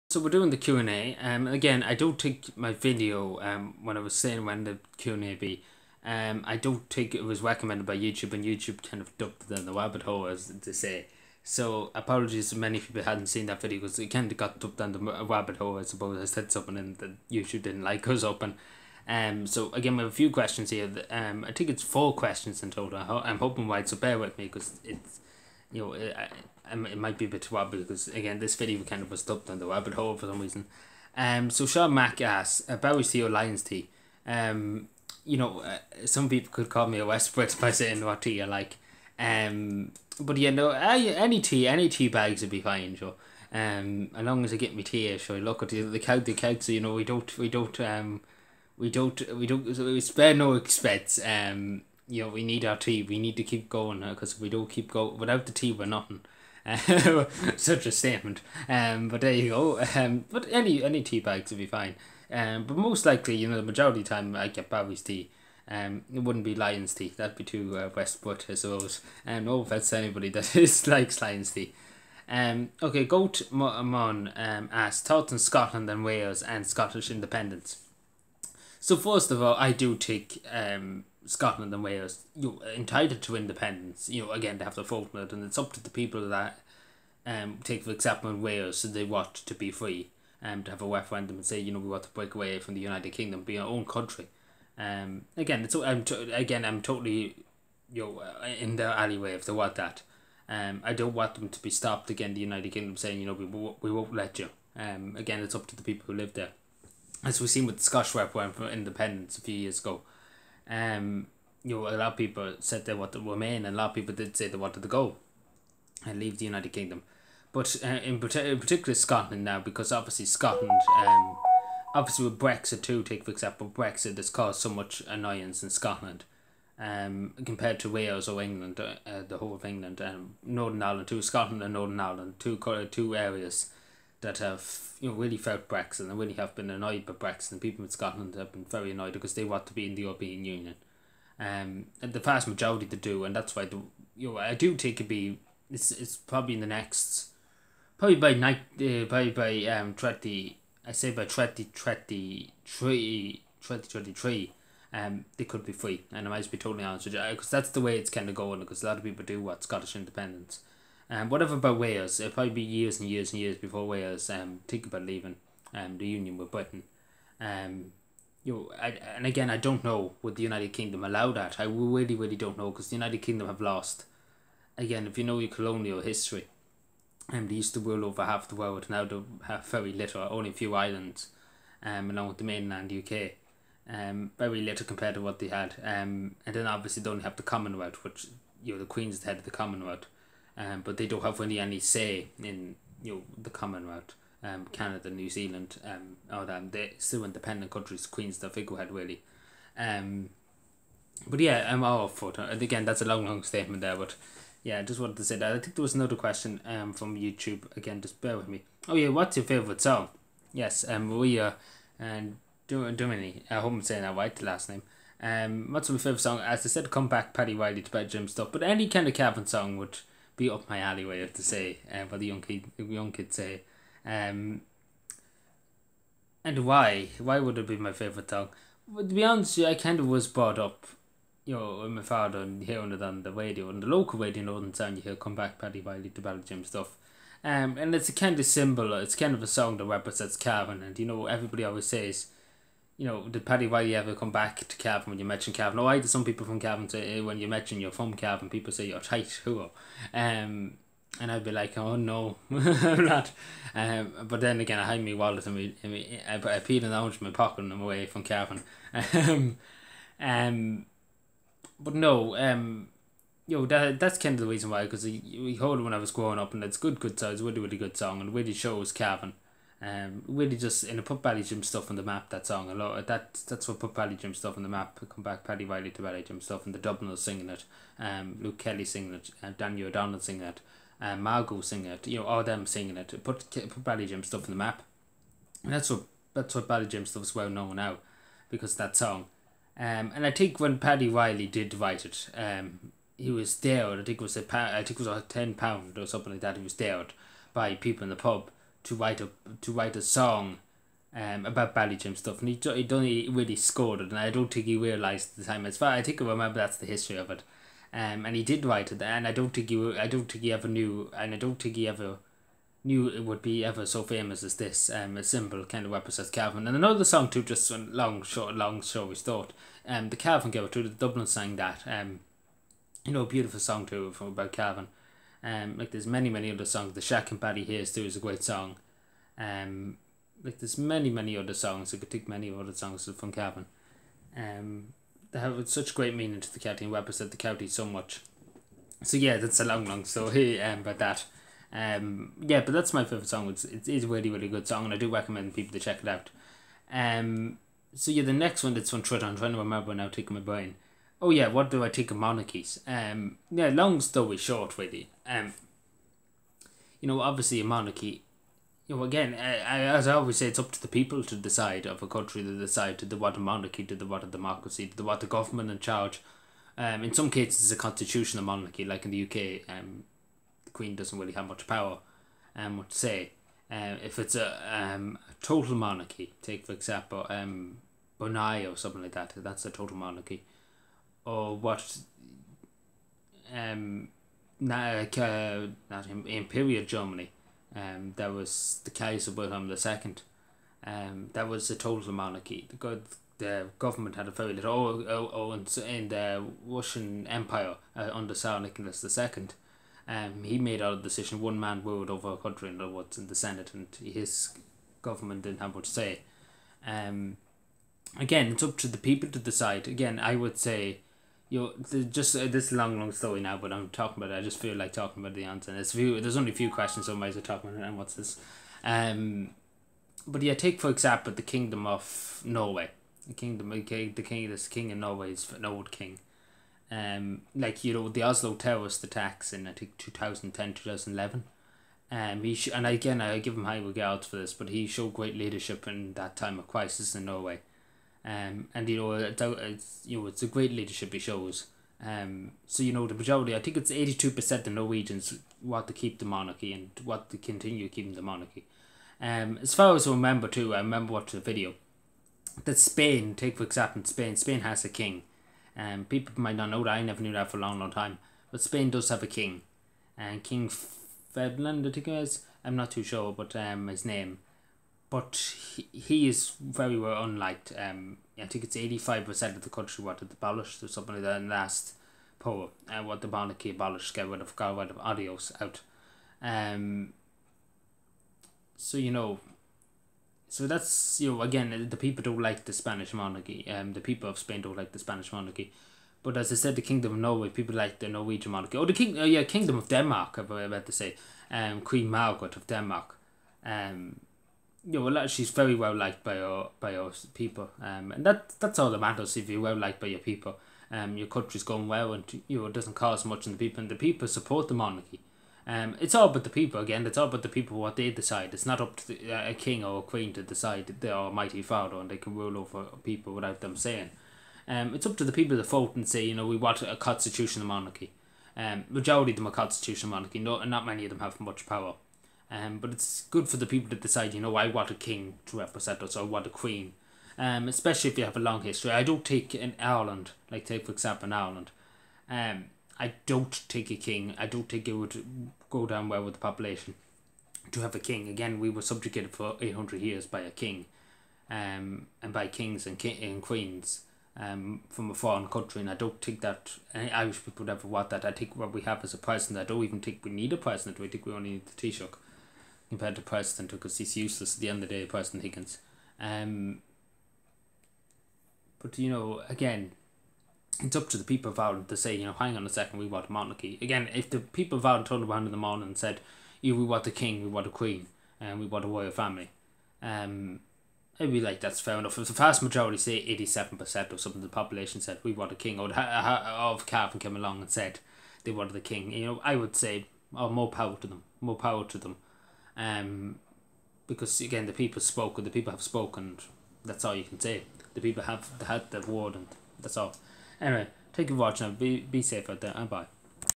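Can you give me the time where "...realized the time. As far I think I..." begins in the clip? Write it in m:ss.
5:04.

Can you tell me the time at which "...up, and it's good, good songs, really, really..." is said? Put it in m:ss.
4:26.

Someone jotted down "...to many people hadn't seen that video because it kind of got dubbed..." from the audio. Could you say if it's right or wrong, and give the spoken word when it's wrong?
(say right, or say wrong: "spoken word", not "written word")
right.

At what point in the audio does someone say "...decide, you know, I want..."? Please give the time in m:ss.
8:43.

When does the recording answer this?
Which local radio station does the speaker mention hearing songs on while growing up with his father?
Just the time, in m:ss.
3:54.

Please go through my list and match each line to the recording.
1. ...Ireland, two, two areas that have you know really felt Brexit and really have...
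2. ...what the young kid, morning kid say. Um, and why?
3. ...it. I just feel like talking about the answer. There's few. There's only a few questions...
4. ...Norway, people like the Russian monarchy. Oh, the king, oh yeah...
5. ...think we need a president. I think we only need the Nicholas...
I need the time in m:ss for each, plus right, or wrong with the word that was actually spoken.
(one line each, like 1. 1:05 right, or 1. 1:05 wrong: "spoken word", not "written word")
1. 2:11 right
2. 3:42 wrong: "young", not "morning"
3. 6:54 right
4. 8:07 wrong: "Norwegian", not "Russian"
5. 9:10 wrong: "Taoiseach", not "Nicholas".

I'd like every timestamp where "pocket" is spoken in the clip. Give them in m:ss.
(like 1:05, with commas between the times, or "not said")
4:17.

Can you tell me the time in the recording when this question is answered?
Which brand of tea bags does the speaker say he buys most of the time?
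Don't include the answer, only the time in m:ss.
1:04.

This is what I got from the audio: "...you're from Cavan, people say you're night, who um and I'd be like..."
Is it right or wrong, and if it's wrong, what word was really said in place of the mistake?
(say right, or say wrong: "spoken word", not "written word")
wrong: "tight", not "night".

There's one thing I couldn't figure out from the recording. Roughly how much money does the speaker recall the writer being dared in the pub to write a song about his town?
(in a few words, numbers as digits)
10 pounds.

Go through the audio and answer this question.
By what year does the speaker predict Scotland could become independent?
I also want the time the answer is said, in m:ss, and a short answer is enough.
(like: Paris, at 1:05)
2023, at 2:31.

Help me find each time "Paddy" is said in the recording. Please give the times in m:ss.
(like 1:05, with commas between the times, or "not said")
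3:37, 3:55, 4:03, 4:35, 4:50, 5:27.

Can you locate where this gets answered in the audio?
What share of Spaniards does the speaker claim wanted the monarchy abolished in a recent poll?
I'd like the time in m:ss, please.
7:48.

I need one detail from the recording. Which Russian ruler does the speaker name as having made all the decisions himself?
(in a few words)
Tsar Nicholas II.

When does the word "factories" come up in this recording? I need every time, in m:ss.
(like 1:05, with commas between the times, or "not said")
not said.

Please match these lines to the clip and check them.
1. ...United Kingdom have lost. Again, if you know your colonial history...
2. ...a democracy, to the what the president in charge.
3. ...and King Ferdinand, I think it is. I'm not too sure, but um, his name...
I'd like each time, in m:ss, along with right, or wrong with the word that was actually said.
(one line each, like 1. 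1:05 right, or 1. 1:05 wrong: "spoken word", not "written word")
1. 2:52 right
2. 6:04 wrong: "government", not "president"
3. 7:40 right.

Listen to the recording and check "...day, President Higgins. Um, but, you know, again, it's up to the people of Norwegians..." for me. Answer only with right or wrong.
wrong.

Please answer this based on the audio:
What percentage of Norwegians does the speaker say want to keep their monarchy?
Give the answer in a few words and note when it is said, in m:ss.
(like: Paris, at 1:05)
82%, at 7:23.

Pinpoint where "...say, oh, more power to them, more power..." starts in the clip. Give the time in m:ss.
9:39.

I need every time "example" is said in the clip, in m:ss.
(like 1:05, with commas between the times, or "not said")
1:27, 2:03, 6:16, 7:00, 7:33, 8:50.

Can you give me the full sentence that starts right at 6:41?
One man ruled over a country and what's in the Senate, and his government didn't have much say.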